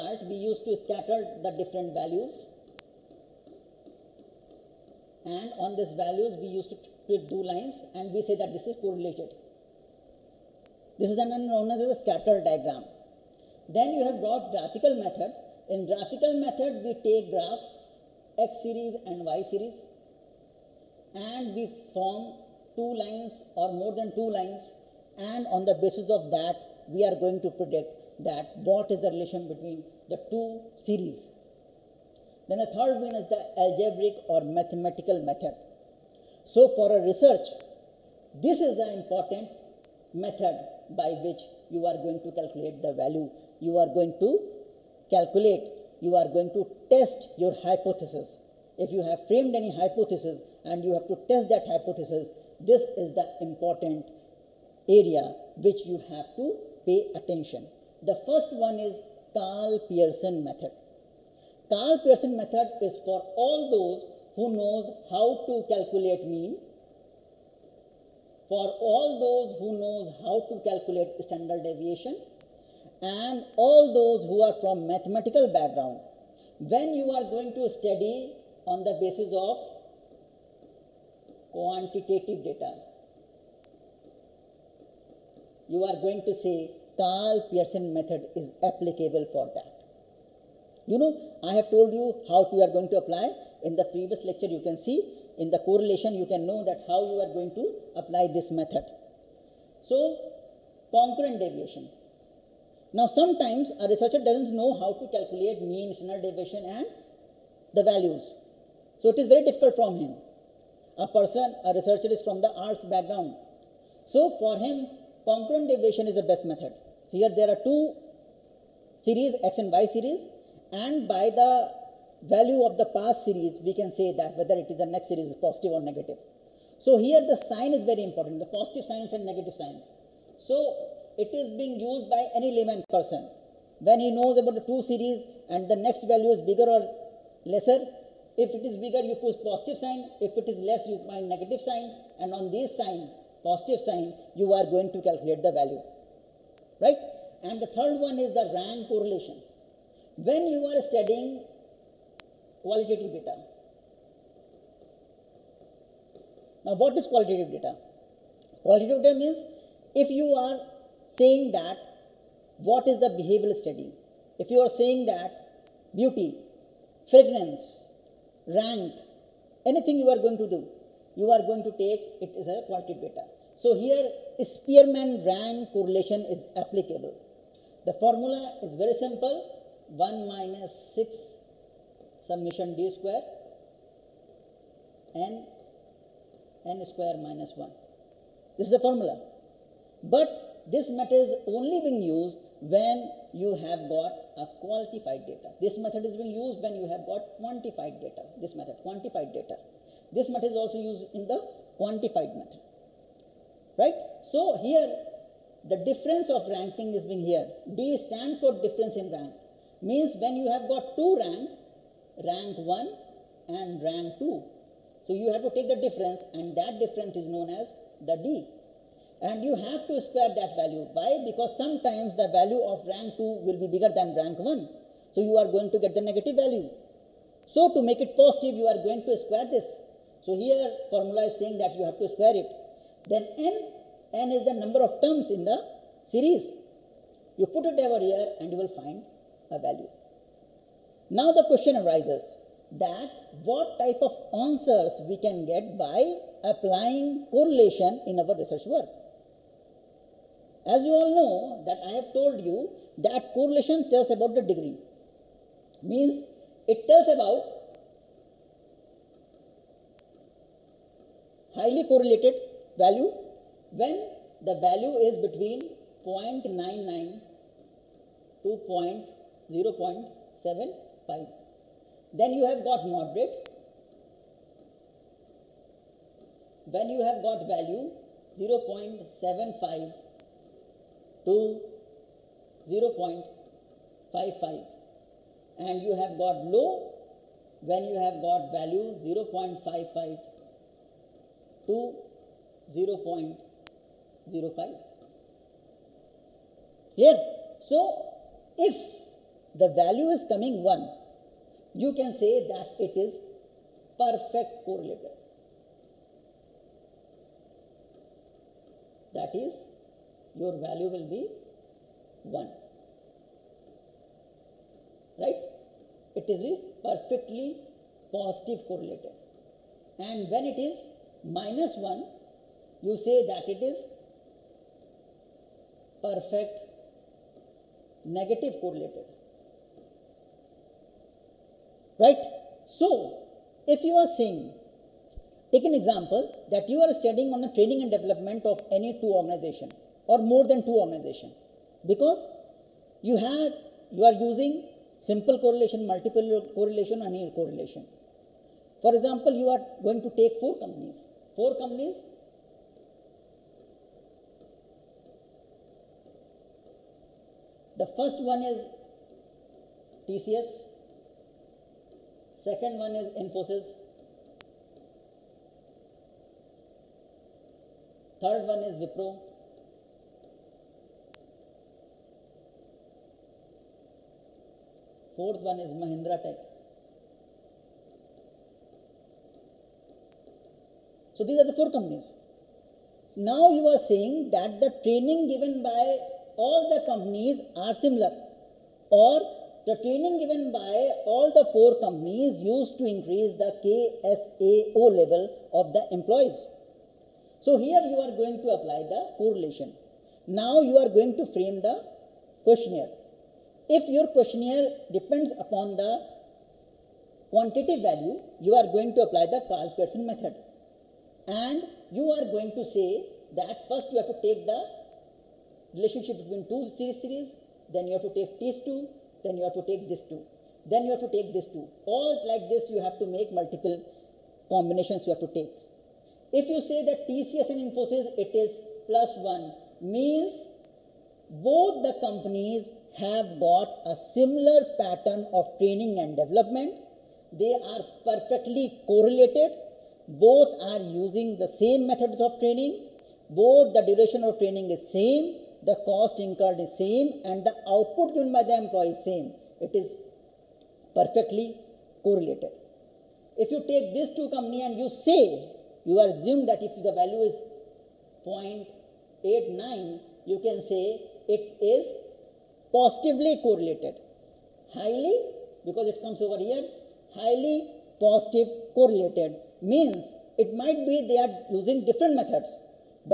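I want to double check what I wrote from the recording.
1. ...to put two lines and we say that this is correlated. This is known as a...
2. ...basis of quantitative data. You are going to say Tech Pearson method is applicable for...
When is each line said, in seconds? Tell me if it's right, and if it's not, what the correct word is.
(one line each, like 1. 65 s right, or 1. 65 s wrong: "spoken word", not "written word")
1. 6 s right
2. 79 s wrong: "Karl", not "Tech".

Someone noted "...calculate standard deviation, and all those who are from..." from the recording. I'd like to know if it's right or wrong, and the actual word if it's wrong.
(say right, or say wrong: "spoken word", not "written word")
right.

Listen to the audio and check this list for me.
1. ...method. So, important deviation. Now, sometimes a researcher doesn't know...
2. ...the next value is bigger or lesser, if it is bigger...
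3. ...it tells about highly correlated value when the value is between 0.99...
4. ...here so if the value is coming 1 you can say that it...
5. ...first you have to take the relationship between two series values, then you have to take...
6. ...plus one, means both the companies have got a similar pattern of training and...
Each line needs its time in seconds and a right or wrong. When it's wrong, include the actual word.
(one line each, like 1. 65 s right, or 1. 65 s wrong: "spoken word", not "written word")
1. 98 s wrong: "concurrent", not "important"
2. 135 s right
3. 256 s right
4. 296 s right
5. 413 s wrong: "series", not "values"
6. 428 s right.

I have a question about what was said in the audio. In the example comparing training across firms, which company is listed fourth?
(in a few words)
Mahindra Tech.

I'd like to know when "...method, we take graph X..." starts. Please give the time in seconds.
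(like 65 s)
16 s.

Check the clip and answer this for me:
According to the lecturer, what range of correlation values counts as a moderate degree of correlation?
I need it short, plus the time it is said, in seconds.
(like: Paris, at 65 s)
0.75 to 0.55, at 278 s.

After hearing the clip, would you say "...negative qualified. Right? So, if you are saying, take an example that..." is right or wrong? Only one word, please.
wrong.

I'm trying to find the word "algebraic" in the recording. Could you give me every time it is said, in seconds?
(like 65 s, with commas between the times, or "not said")
33 s.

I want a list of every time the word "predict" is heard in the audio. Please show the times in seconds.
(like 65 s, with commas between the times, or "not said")
27 s.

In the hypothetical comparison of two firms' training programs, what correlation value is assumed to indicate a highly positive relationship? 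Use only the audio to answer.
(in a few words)
0.89.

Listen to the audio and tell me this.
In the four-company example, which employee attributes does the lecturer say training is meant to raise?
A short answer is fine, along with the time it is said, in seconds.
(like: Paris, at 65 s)
KSAO, at 393 s.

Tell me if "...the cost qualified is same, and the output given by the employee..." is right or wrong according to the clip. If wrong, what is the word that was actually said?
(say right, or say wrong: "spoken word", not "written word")
wrong: "incurred", not "qualified".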